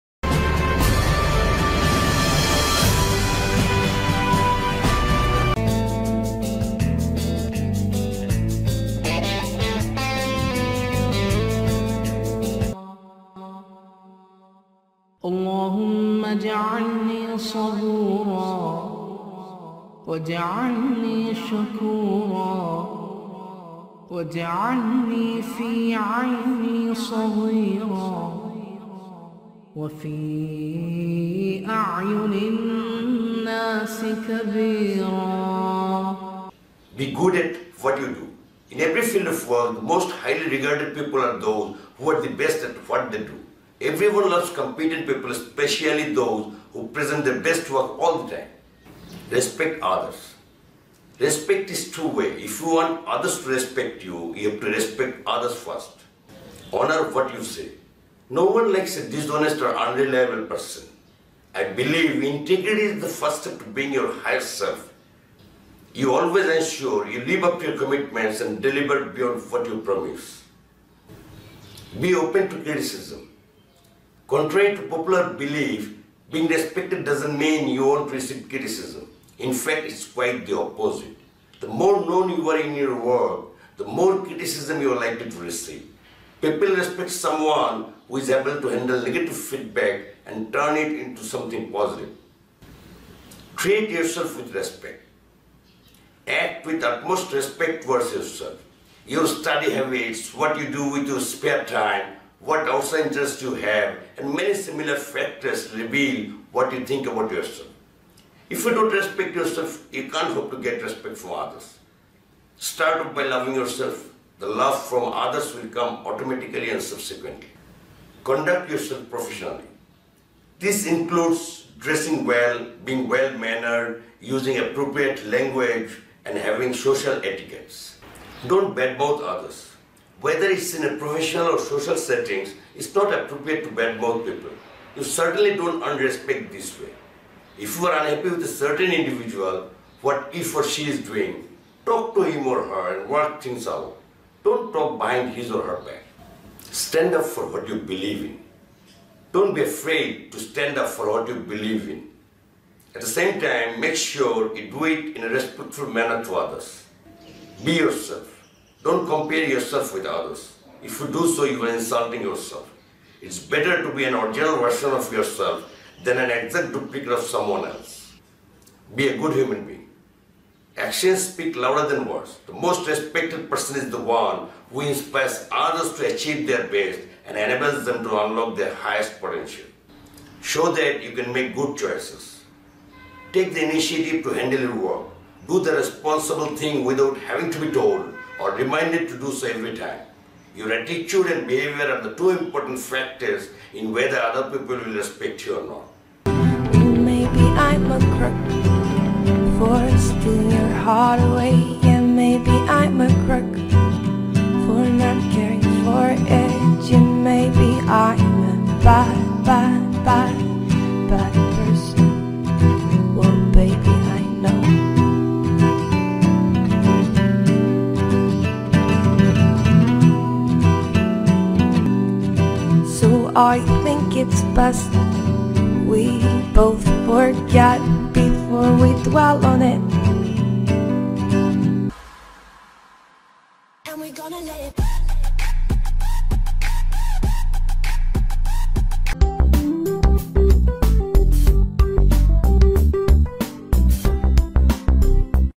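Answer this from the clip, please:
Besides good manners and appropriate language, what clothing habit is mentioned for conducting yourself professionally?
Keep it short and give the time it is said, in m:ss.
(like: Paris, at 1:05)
Dressing well, at 2:01.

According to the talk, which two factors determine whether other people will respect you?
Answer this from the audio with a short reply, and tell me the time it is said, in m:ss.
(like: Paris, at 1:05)
Attitude and behavior, at 3:10.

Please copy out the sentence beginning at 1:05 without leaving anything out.
You always ensure you live up to your commitments and deliver beyond what you promise.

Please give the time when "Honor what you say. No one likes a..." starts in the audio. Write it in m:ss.
0:56.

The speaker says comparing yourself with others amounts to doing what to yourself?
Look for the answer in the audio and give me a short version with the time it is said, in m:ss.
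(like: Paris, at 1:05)
Insulting yourself, at 2:41.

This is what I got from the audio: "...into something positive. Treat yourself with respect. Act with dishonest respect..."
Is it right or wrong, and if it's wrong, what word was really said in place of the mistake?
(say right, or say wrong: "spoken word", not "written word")
wrong: "utmost", not "dishonest".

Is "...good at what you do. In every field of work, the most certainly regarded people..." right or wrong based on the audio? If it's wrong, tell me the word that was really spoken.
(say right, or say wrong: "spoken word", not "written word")
wrong: "highly", not "certainly".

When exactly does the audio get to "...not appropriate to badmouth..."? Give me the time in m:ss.
2:12.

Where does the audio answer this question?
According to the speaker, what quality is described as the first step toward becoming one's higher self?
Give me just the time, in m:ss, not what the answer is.
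1:02.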